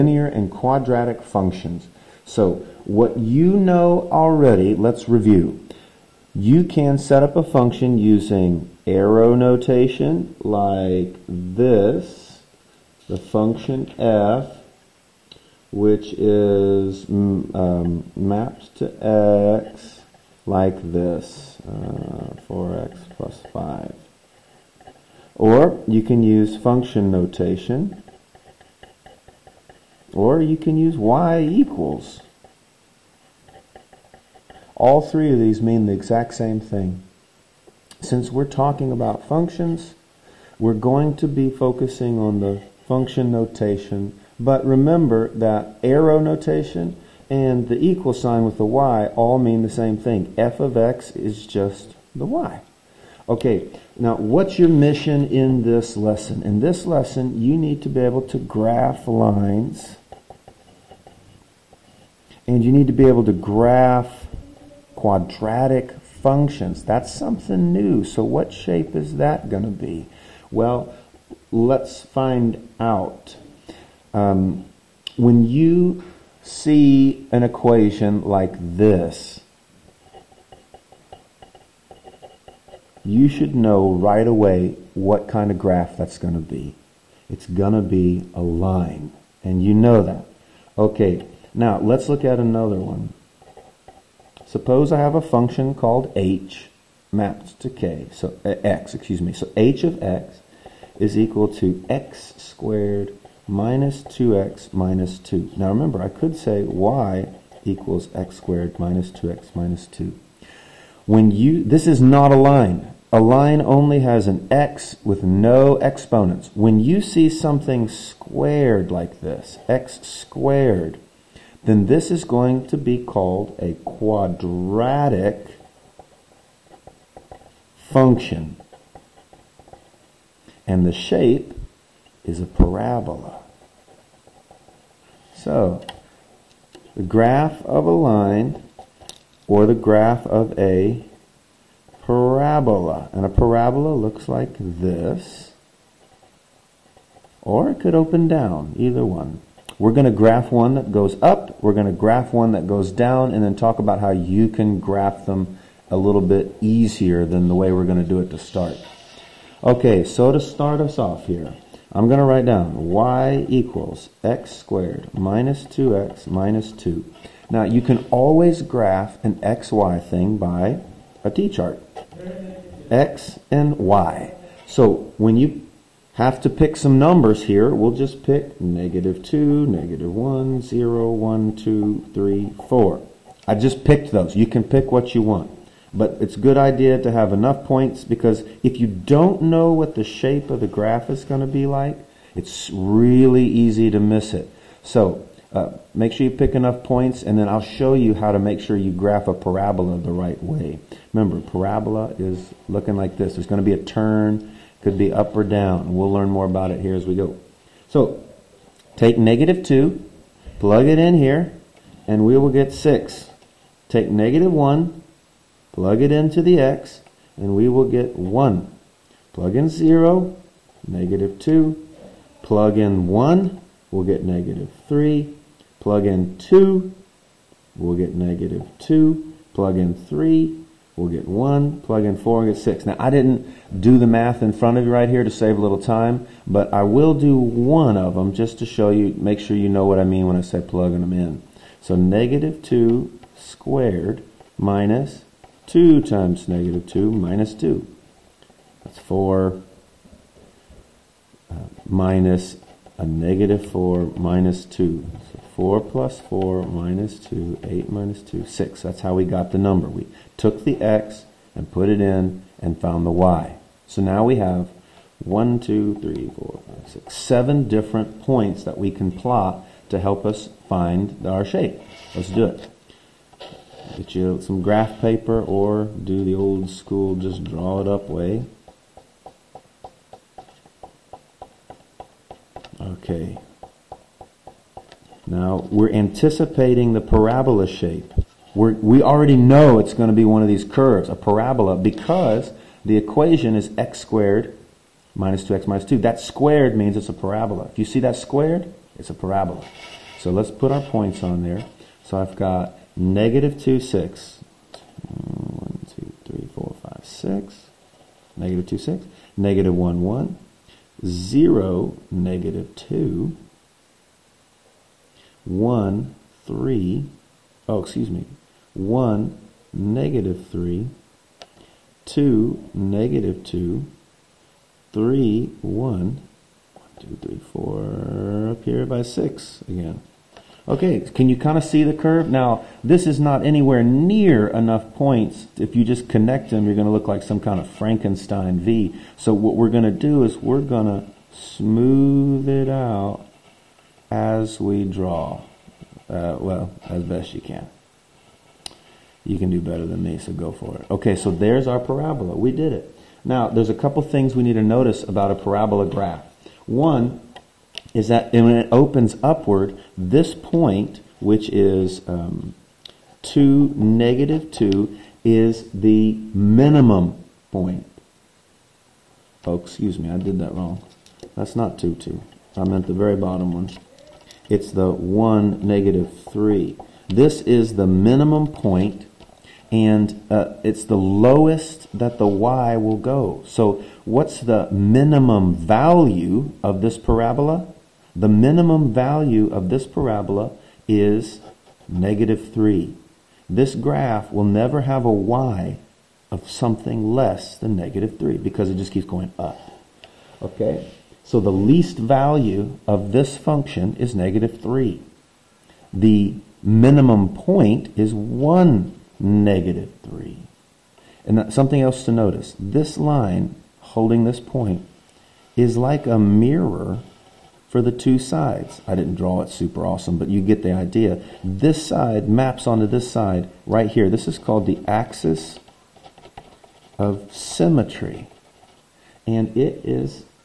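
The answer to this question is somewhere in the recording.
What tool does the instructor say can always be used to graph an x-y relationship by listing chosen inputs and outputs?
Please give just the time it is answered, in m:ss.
2:51.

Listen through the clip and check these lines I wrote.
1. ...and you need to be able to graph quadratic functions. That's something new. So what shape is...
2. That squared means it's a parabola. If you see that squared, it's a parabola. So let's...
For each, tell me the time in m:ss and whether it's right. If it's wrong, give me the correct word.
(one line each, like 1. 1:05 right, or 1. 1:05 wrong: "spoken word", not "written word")
1. 1:02 right
2. 4:55 right.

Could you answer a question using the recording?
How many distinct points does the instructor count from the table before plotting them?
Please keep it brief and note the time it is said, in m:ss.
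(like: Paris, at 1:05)
7, at 4:27.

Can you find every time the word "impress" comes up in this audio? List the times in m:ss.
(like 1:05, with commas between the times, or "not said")
not said.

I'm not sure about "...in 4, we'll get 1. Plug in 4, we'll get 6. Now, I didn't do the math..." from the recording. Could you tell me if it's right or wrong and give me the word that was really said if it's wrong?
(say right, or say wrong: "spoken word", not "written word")
wrong: "3", not "4".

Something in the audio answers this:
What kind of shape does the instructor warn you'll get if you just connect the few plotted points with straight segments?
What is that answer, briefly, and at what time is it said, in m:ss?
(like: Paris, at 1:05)
Frankenstein V, at 5:37.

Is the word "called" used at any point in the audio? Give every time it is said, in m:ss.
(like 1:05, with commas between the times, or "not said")
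1:35, 2:03, 7:04.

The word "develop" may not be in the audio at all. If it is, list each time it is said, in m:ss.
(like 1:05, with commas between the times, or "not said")
not said.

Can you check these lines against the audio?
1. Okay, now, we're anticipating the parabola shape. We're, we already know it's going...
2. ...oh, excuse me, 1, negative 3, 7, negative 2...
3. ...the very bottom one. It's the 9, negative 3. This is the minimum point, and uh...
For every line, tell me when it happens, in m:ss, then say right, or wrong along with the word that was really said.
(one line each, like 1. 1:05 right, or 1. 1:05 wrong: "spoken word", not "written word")
1. 4:42 right
2. 5:17 wrong: "2", not "7"
3. 6:12 wrong: "1", not "9".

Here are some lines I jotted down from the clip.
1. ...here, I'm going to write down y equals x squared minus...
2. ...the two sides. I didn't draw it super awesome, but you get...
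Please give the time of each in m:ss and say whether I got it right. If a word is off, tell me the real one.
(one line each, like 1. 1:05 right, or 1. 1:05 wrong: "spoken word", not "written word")
1. 2:41 right
2. 6:57 right.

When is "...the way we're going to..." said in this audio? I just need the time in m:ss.
2:37.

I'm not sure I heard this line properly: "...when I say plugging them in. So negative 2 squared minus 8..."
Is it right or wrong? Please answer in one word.
wrong.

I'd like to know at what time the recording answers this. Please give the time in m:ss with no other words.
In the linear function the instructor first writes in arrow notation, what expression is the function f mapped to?
0:22.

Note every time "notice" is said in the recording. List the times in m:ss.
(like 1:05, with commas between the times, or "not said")
5:54, 6:52.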